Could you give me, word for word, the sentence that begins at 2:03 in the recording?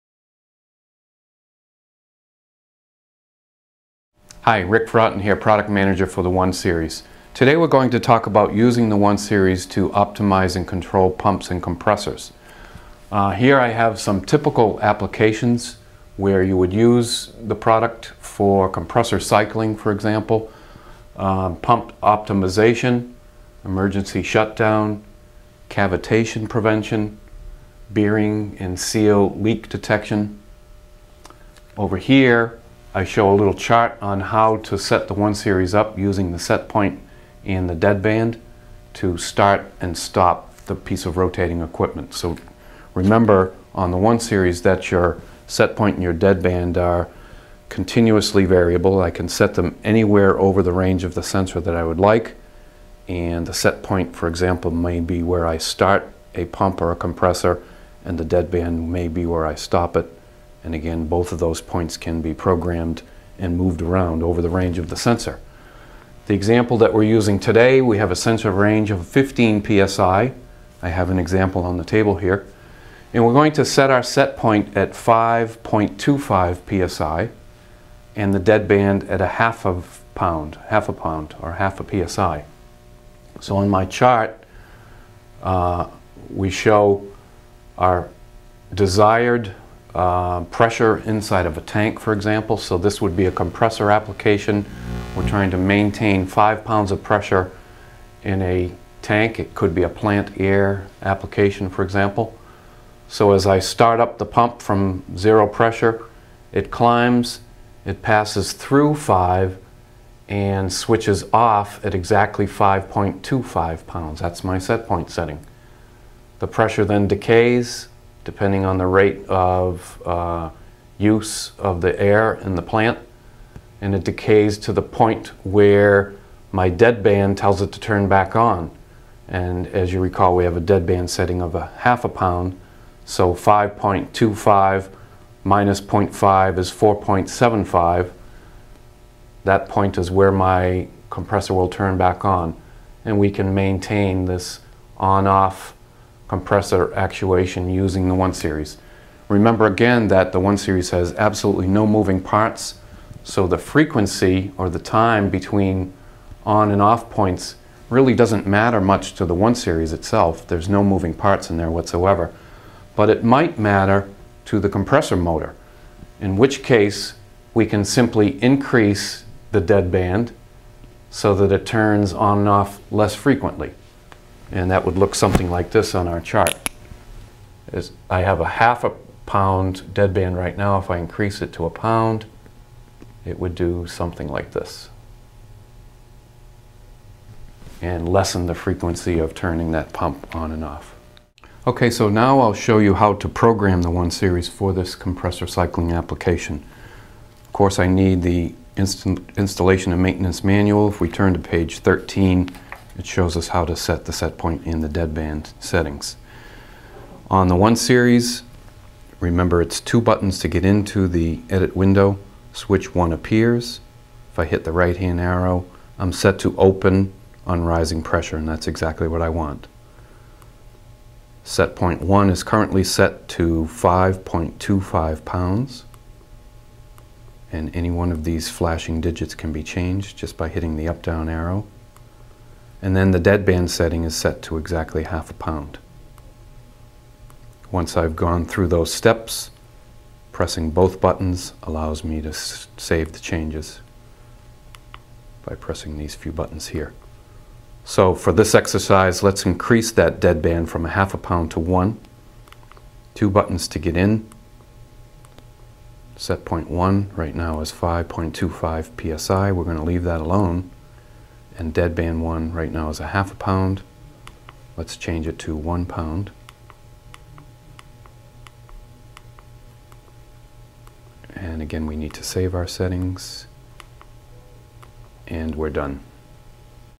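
And it decays to the point where my dead band tells it to turn back on.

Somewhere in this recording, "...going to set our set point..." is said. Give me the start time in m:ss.
1:13.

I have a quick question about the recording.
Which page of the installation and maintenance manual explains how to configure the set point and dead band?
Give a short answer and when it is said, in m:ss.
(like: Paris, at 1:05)
13, at 3:21.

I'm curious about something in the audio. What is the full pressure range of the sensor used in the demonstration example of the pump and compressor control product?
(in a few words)
15 psi.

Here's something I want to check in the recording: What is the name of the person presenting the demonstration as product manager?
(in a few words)
Rick Broughton.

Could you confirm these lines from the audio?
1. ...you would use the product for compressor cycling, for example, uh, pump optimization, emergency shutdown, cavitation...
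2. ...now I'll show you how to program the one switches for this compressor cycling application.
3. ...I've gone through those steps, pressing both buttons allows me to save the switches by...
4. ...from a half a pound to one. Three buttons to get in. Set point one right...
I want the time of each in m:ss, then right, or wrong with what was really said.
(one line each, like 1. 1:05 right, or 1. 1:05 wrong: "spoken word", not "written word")
1. 0:16 right
2. 3:12 wrong: "series", not "switches"
3. 3:57 wrong: "changes", not "switches"
4. 4:10 wrong: "Two", not "Three".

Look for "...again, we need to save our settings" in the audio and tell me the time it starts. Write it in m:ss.
4:31.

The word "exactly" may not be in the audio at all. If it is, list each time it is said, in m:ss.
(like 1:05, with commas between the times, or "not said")
1:51, 3:38, 3:54.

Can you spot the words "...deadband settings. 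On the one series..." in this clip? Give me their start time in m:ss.
3:24.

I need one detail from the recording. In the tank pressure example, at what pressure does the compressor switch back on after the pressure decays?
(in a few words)
4.75.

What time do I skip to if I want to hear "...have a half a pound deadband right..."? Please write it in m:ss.
2:58.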